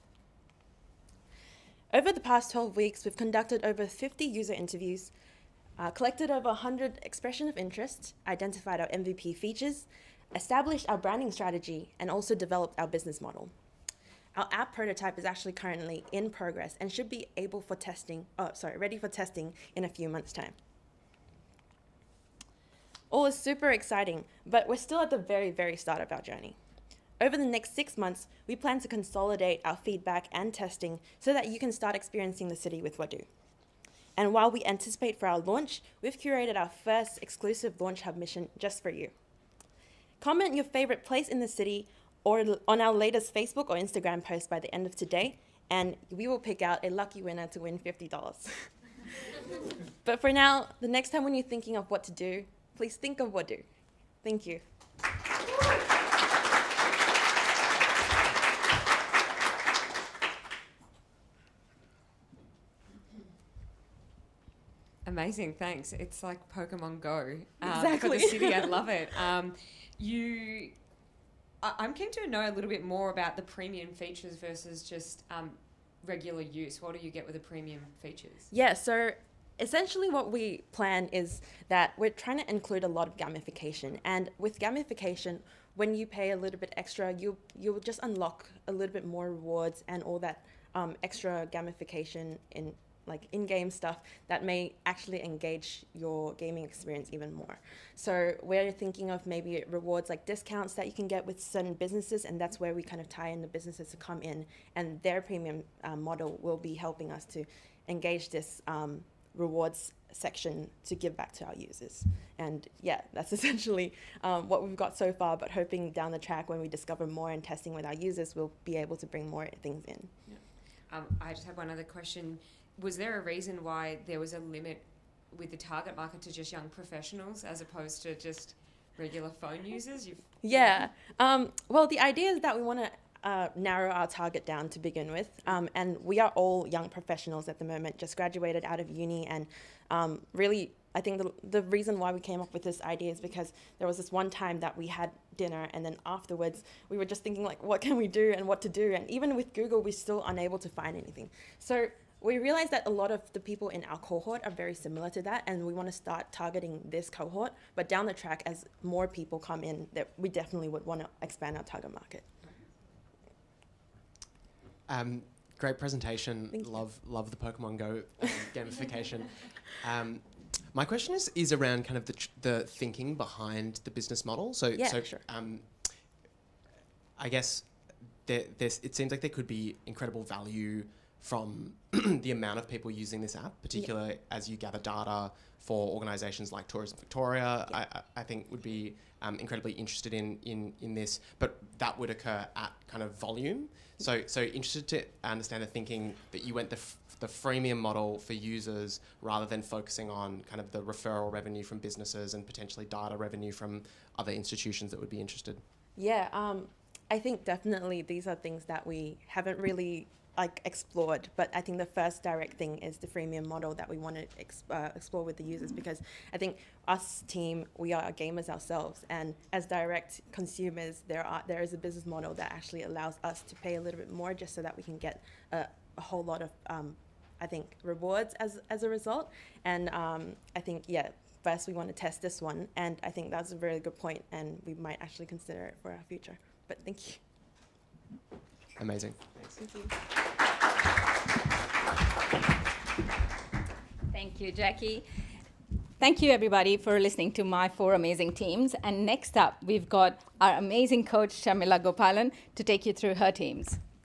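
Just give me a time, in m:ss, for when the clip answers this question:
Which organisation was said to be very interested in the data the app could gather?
3:06.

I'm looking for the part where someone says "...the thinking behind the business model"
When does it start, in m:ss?
2:52.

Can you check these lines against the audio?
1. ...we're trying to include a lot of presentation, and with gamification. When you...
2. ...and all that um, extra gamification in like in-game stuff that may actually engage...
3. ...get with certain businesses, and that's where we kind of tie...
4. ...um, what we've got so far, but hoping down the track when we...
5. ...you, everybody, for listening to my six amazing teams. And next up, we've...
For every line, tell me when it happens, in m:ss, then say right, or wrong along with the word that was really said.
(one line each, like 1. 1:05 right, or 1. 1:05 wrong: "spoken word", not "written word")
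1. 1:21 wrong: "gamification", not "presentation"
2. 1:29 right
3. 1:41 right
4. 1:54 right
5. 4:06 wrong: "four", not "six".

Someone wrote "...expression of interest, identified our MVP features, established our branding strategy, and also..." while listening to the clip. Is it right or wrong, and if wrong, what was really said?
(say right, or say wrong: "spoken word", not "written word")
right.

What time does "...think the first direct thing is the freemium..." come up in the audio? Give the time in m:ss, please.
3:31.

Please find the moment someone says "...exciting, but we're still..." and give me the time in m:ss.
0:23.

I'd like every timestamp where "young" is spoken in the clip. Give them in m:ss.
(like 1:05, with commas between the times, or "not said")
2:06, 2:16.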